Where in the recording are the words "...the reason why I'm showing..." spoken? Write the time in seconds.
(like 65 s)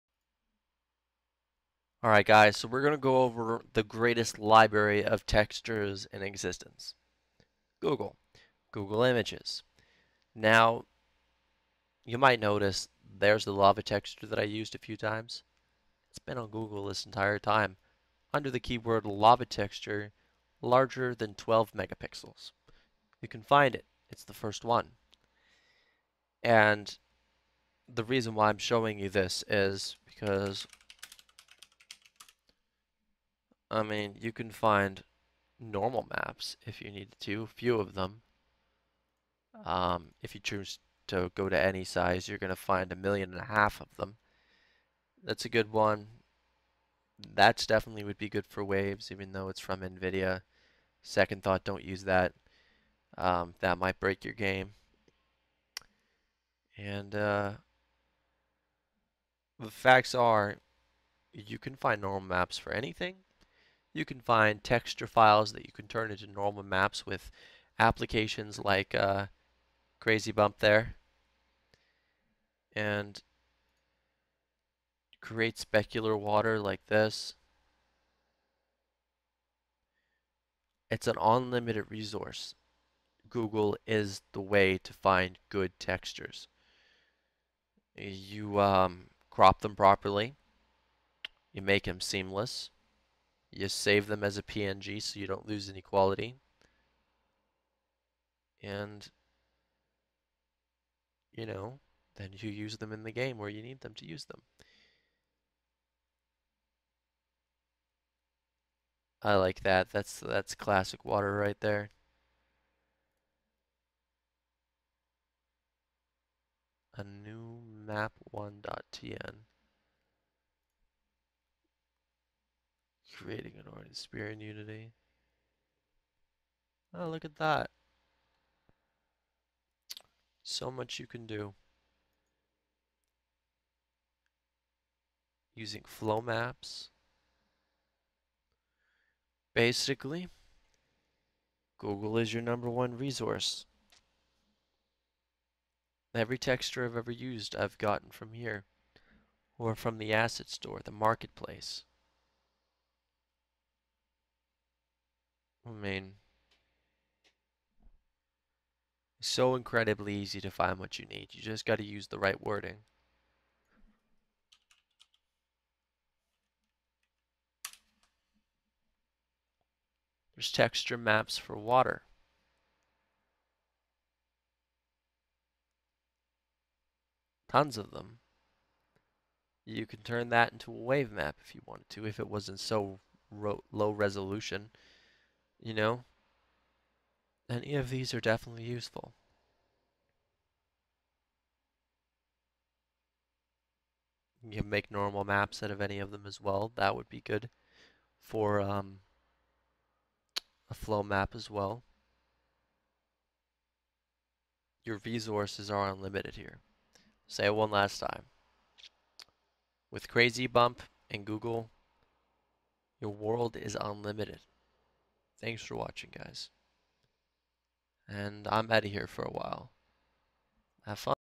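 27 s.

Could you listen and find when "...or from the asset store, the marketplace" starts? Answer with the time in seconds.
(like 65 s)
149 s.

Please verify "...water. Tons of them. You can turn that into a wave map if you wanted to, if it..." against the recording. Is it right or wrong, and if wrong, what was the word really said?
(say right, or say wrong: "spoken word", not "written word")
right.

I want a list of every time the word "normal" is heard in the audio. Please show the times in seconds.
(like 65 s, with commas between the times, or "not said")
35 s, 62 s, 66 s, 194 s.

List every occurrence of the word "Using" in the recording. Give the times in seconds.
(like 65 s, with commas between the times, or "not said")
135 s.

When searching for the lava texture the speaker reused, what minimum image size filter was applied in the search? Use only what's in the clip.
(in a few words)
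12 megapixels.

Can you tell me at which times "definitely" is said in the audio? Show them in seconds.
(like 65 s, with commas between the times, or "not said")
47 s, 188 s.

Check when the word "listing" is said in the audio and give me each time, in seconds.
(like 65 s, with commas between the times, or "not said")
not said.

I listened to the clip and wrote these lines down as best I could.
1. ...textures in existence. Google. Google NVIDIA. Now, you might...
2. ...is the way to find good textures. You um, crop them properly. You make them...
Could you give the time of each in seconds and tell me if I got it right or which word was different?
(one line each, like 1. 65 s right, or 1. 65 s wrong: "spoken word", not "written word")
1. 5 s wrong: "Images", not "NVIDIA"
2. 83 s right.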